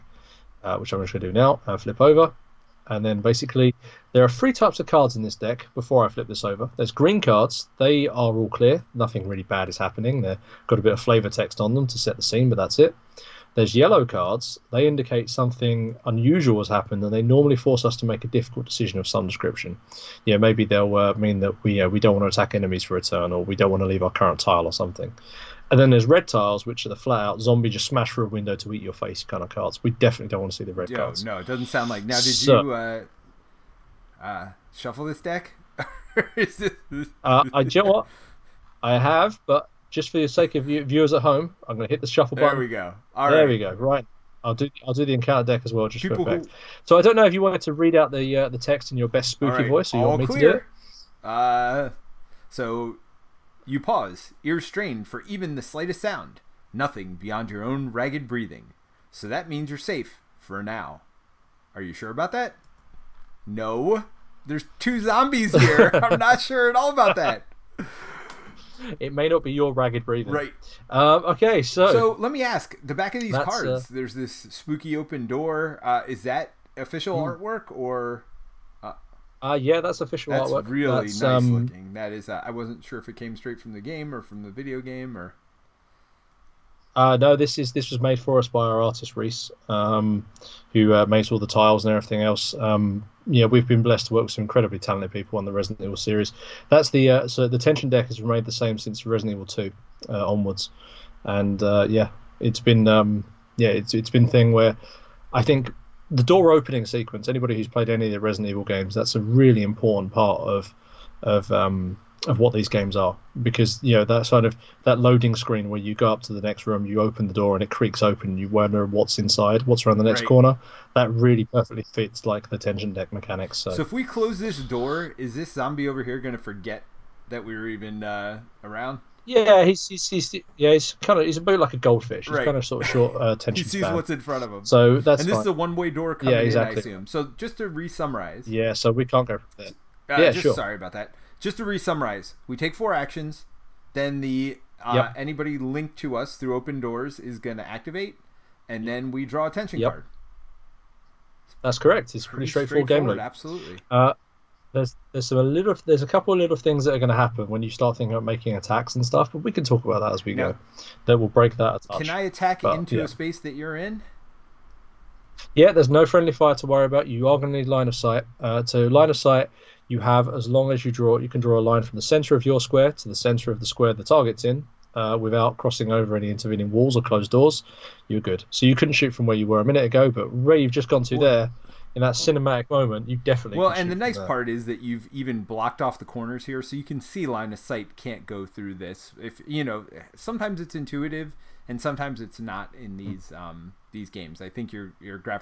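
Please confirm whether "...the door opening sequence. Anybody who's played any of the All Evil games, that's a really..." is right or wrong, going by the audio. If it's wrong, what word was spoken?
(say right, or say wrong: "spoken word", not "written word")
wrong: "Resident", not "All".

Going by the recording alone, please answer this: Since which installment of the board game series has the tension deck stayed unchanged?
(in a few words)
Resident Evil Two.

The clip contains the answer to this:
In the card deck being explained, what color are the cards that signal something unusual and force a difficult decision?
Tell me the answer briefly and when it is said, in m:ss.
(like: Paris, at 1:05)
Yellow, at 0:13.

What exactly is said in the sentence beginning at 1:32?
Um, yeah, we've been blessed to work with some incredibly talented people on the Resident Evil series.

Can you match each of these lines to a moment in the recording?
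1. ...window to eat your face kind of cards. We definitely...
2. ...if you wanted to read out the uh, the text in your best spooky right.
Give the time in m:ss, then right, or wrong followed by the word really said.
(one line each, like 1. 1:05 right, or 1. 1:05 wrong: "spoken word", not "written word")
1. 0:28 right
2. 0:47 right.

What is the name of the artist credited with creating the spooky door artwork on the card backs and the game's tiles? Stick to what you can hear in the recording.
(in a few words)
Reese.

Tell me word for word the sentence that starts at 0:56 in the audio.
Nothing beyond your own ragged breathing.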